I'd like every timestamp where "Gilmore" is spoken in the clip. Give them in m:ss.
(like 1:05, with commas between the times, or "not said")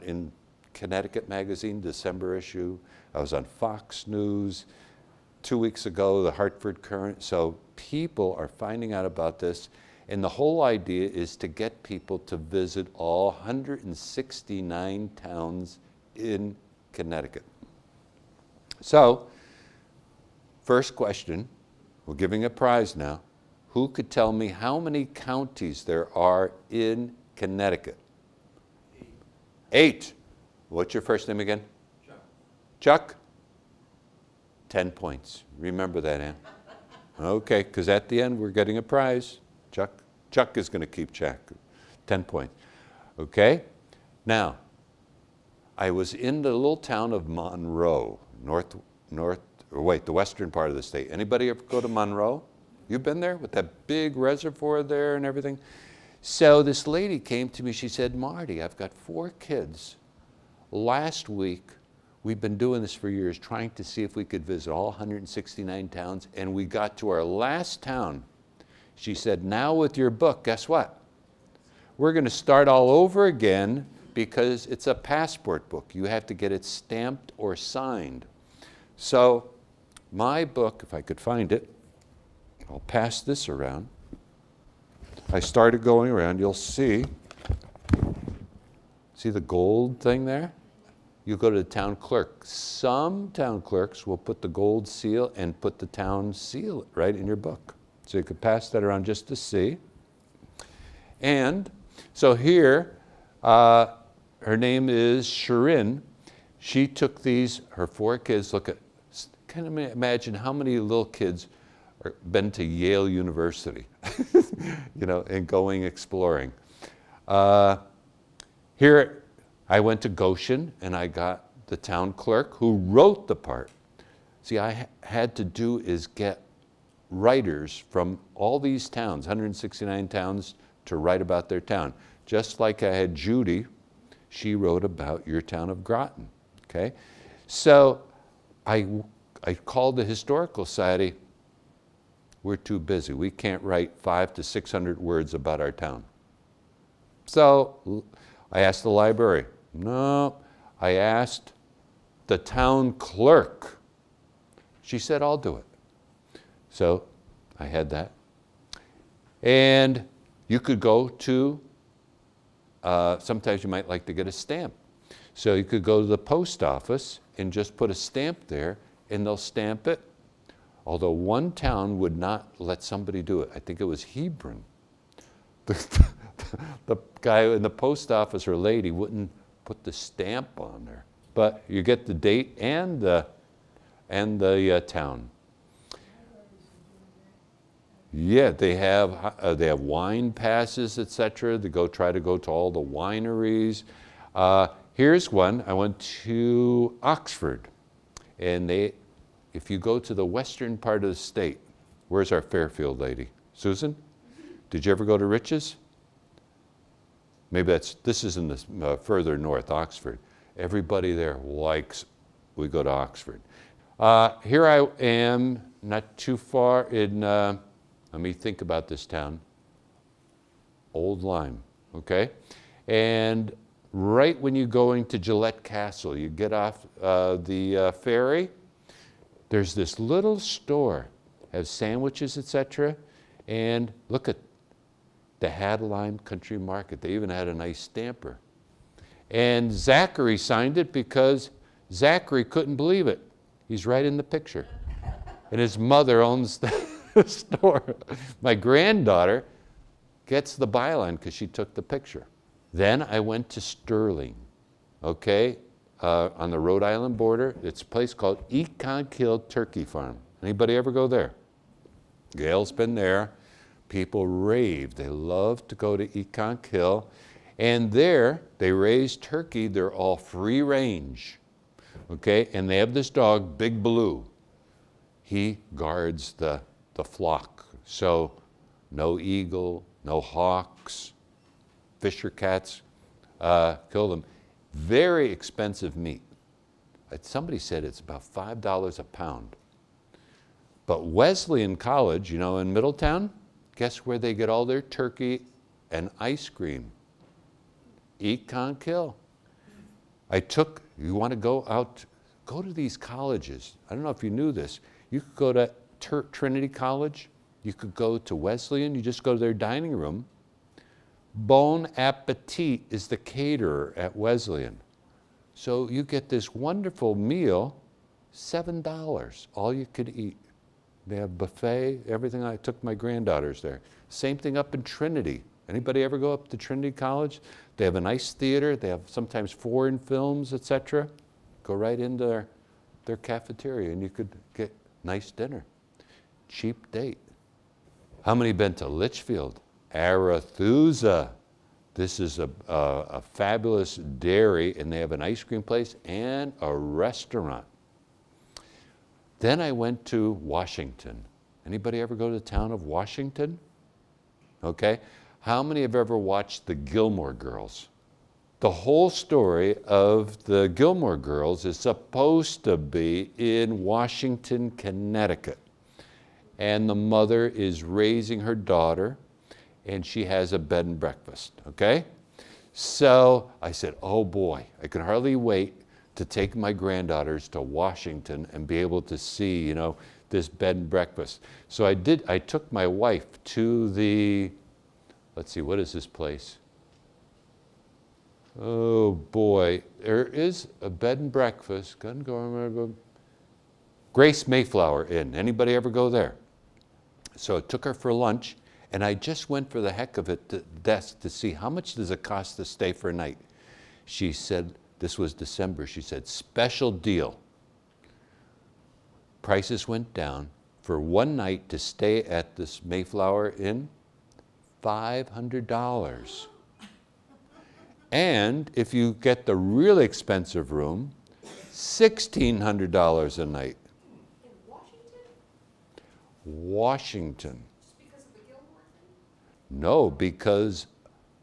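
5:56, 6:00.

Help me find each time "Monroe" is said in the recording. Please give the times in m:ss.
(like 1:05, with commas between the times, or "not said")
0:47, 0:51.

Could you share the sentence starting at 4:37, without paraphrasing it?
So no eagle, no hawks, fisher cats uh, kill them.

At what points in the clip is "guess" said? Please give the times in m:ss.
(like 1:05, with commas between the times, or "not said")
1:10, 4:53.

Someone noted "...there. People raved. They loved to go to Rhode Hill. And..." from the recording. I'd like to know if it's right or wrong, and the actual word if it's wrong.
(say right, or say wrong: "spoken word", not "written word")
wrong: "Ekonk", not "Rhode".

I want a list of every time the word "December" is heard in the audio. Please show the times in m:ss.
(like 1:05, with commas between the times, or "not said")
0:01, 6:45.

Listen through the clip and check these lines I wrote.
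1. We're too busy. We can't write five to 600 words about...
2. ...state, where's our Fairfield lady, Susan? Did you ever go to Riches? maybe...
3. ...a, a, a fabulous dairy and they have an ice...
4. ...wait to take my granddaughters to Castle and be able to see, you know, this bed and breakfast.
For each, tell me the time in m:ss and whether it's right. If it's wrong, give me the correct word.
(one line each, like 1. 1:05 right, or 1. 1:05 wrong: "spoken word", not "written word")
1. 2:22 right
2. 3:21 right
3. 5:42 right
4. 6:15 wrong: "Washington", not "Castle".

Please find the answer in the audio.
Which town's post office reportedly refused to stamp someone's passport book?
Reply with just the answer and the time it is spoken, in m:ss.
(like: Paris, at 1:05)
Hebron, at 2:54.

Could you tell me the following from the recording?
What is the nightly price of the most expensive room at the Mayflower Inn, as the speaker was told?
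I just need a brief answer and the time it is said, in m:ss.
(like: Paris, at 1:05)
$1,600, at 7:01.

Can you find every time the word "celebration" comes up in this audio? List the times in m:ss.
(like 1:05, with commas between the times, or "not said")
not said.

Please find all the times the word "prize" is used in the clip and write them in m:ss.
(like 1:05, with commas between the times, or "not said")
0:22, 0:38.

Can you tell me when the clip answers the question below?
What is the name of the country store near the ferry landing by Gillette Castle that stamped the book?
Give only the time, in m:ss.
3:55.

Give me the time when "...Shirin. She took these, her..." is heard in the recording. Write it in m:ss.
1:45.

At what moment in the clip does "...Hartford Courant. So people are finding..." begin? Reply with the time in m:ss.
0:06.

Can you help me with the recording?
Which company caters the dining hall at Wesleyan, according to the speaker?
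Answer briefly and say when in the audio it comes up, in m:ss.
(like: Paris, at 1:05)
Bon Appetit, at 5:11.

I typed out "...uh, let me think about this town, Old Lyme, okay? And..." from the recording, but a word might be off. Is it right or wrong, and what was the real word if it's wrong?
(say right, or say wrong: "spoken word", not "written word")
right.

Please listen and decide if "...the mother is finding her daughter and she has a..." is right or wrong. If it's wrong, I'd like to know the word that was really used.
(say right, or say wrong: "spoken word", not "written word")
wrong: "raising", not "finding".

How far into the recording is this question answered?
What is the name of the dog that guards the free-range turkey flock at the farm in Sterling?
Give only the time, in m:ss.
4:33.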